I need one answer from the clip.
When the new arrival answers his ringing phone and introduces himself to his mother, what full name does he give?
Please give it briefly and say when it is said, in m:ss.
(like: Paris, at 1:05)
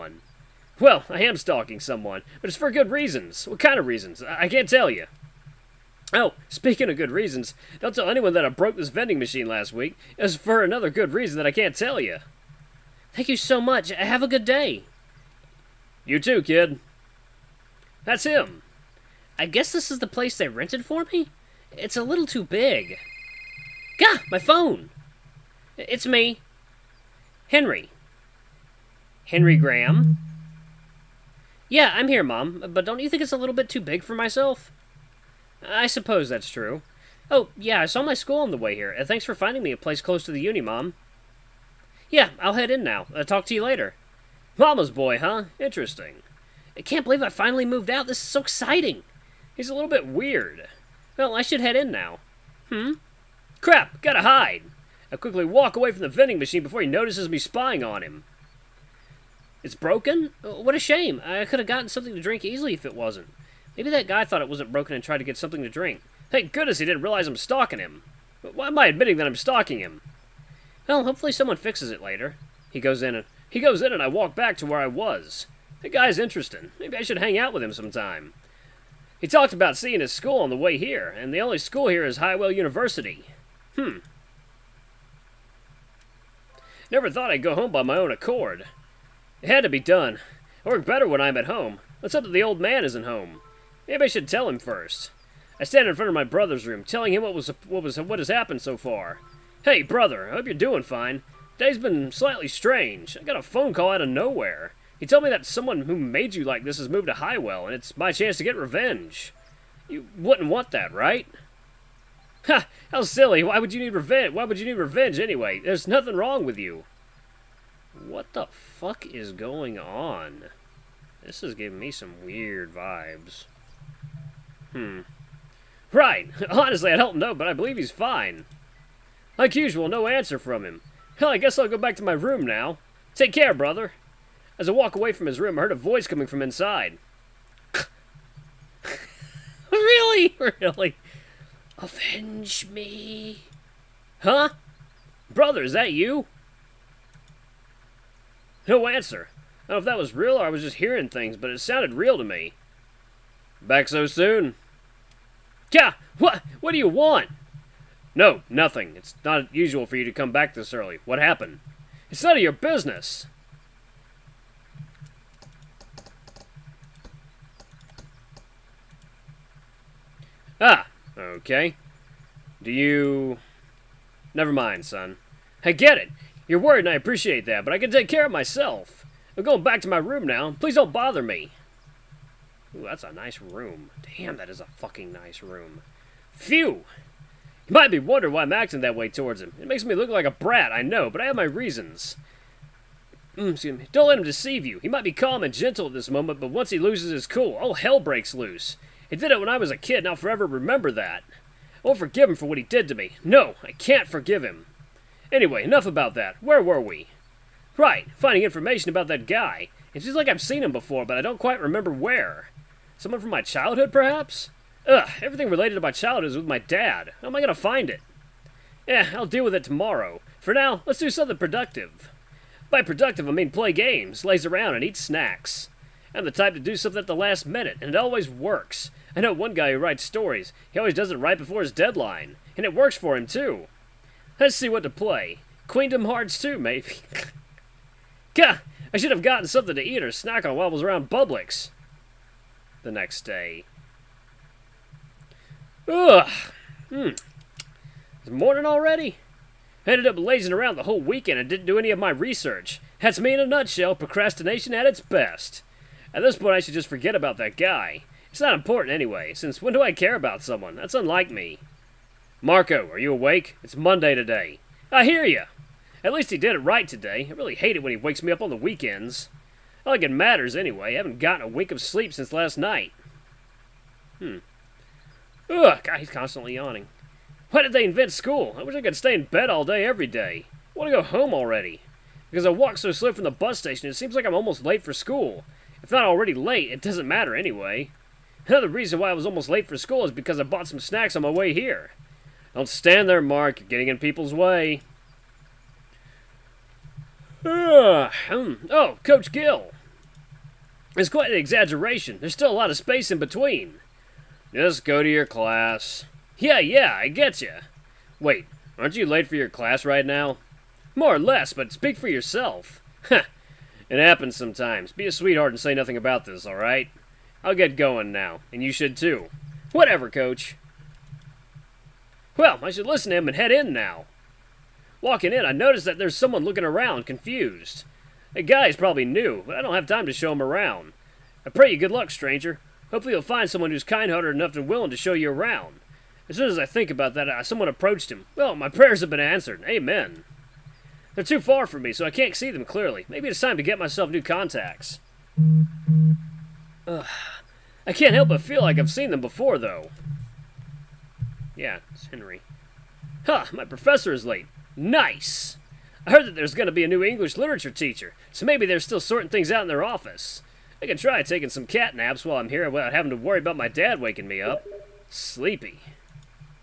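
Henry Graham, at 0:29.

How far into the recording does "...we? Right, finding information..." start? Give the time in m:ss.
3:26.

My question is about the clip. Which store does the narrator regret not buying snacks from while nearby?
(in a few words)
Publix.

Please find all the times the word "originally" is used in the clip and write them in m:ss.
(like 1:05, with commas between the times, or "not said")
not said.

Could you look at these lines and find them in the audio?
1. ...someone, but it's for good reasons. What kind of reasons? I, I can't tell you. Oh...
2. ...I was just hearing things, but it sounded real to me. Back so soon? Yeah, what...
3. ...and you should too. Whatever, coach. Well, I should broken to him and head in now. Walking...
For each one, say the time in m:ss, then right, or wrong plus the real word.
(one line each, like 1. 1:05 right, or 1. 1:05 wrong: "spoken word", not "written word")
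1. 0:01 right
2. 2:30 right
3. 5:18 wrong: "listen", not "broken".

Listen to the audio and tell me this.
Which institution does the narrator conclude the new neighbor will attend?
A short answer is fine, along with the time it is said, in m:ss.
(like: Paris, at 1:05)
Highwell University, at 1:22.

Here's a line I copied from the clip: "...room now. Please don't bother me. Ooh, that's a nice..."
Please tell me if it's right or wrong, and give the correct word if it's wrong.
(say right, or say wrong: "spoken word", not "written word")
right.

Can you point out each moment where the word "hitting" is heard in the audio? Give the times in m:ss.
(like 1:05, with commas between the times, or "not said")
not said.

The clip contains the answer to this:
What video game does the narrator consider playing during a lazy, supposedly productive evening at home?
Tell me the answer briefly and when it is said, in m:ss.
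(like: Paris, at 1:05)
Queendom Hearts 2, at 3:55.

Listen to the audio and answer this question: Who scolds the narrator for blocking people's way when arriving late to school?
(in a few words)
Coach Gill.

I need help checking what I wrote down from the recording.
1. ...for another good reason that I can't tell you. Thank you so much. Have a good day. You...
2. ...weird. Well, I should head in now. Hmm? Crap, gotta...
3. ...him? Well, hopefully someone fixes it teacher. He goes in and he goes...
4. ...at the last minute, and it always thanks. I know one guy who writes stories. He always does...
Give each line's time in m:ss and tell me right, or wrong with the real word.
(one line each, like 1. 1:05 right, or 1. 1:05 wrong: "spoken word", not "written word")
1. 0:10 right
2. 0:50 right
3. 1:09 wrong: "later", not "teacher"
4. 3:46 wrong: "works", not "thanks".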